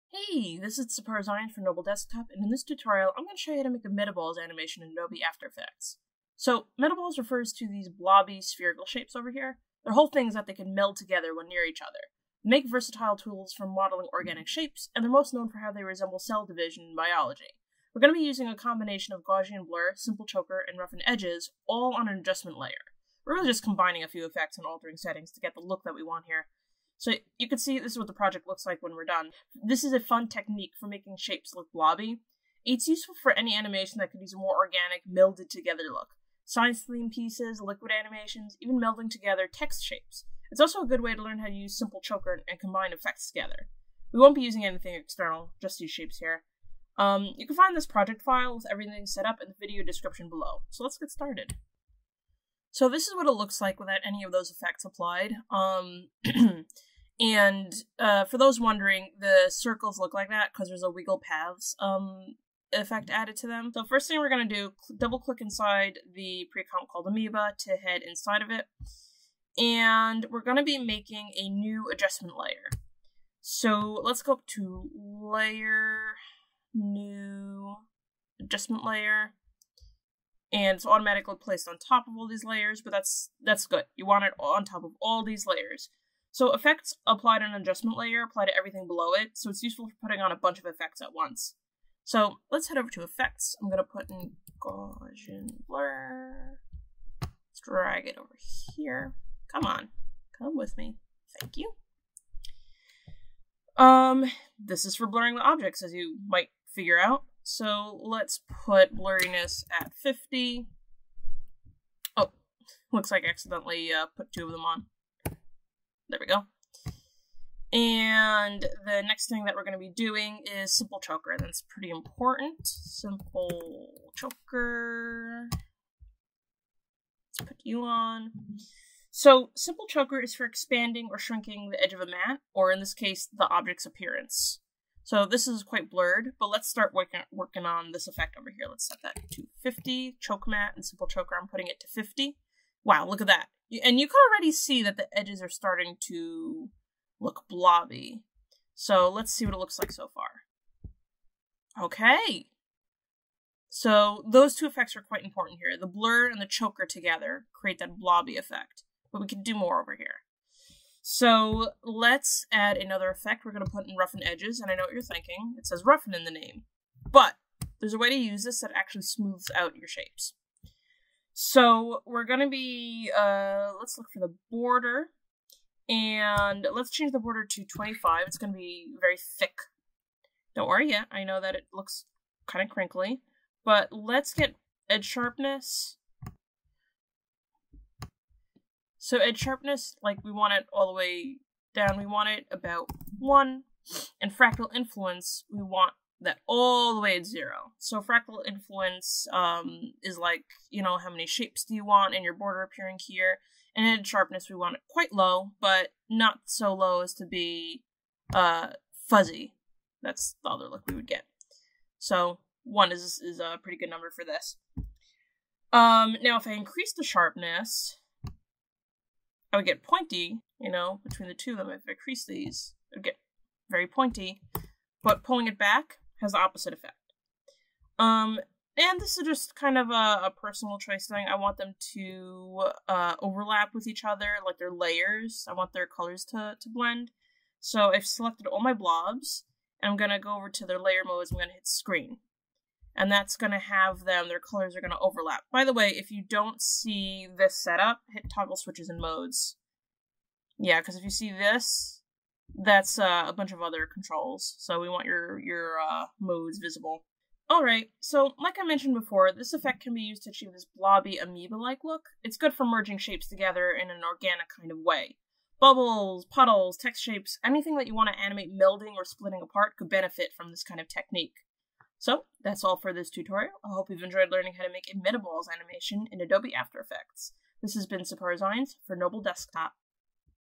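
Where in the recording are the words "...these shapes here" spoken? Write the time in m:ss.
0:45.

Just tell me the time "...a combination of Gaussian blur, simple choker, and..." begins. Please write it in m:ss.
0:18.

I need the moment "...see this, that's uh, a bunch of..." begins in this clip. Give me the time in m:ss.
4:11.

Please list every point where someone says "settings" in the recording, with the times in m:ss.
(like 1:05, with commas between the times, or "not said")
0:24.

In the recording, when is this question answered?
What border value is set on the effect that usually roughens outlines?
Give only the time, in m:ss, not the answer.
2:57.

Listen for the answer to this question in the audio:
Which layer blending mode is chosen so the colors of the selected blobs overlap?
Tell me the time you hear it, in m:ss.
4:01.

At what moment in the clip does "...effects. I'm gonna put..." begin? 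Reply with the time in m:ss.
1:33.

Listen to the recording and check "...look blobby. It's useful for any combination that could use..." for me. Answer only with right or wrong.
wrong.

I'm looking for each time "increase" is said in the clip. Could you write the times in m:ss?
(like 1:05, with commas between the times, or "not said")
3:36, 3:41.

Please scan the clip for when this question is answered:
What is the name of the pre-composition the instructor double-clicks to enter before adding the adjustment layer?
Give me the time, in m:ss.
1:07.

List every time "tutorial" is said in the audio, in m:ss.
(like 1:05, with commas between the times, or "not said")
0:02, 4:33.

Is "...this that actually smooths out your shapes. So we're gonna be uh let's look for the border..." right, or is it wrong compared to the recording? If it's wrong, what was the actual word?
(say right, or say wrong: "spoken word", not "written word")
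right.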